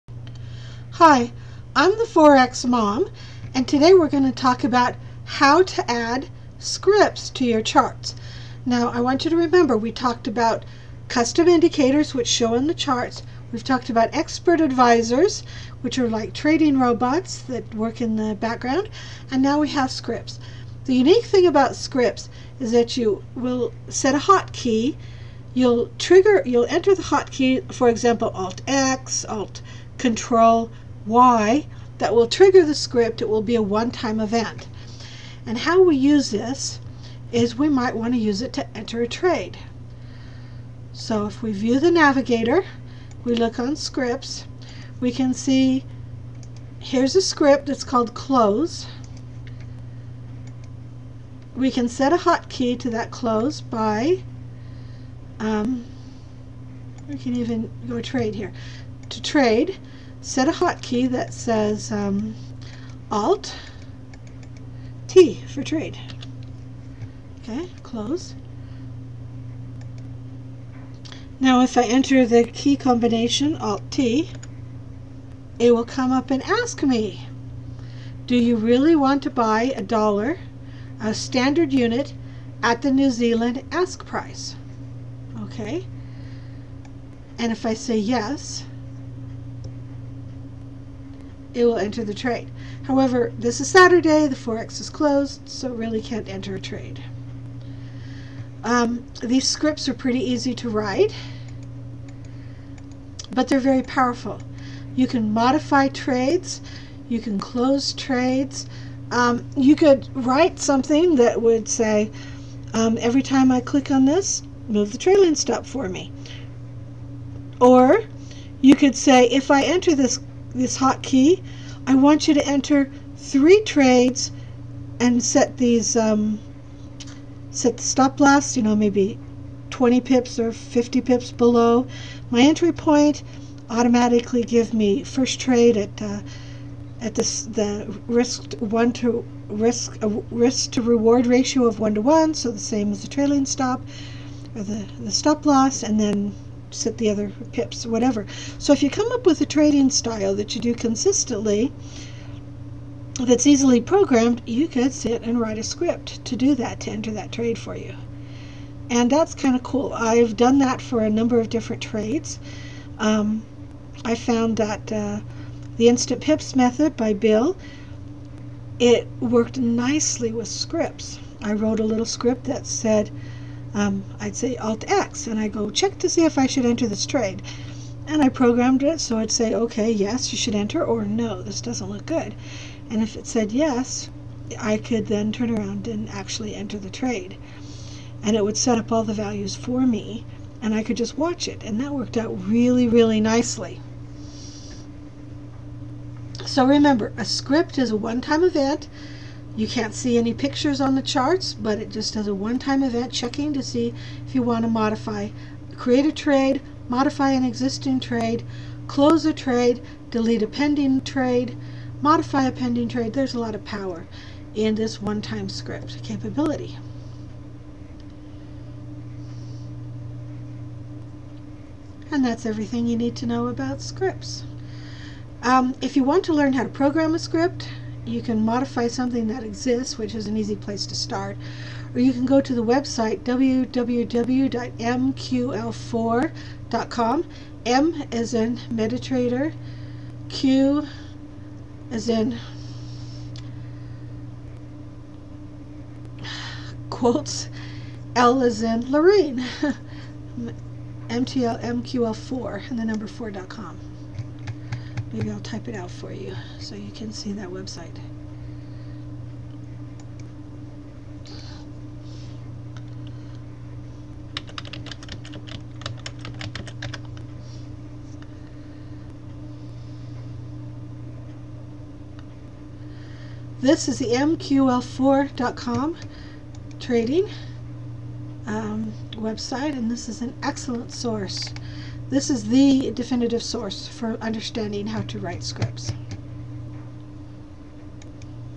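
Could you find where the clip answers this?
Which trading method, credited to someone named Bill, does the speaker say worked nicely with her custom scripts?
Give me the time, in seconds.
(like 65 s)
165 s.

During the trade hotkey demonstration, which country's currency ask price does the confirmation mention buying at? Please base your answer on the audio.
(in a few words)
New Zealand.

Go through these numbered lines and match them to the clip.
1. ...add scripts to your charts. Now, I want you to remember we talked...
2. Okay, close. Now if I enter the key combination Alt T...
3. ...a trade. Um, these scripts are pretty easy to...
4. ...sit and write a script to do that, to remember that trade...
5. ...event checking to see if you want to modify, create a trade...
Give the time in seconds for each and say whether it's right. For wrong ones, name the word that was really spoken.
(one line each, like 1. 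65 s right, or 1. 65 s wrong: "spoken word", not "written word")
1. 5 s right
2. 67 s right
3. 96 s right
4. 154 s wrong: "enter", not "remember"
5. 202 s right.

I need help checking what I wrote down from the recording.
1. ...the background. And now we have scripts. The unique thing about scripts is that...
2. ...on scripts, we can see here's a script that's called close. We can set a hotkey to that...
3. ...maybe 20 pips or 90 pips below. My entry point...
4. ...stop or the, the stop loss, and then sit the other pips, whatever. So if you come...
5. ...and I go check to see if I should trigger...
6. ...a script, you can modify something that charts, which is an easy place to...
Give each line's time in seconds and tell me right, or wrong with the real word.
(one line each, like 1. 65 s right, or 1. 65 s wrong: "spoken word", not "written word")
1. 18 s right
2. 43 s right
3. 128 s wrong: "50", not "90"
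4. 143 s right
5. 175 s wrong: "enter", not "trigger"
6. 227 s wrong: "exists", not "charts".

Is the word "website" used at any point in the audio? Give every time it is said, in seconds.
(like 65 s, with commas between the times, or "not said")
232 s, 257 s, 279 s.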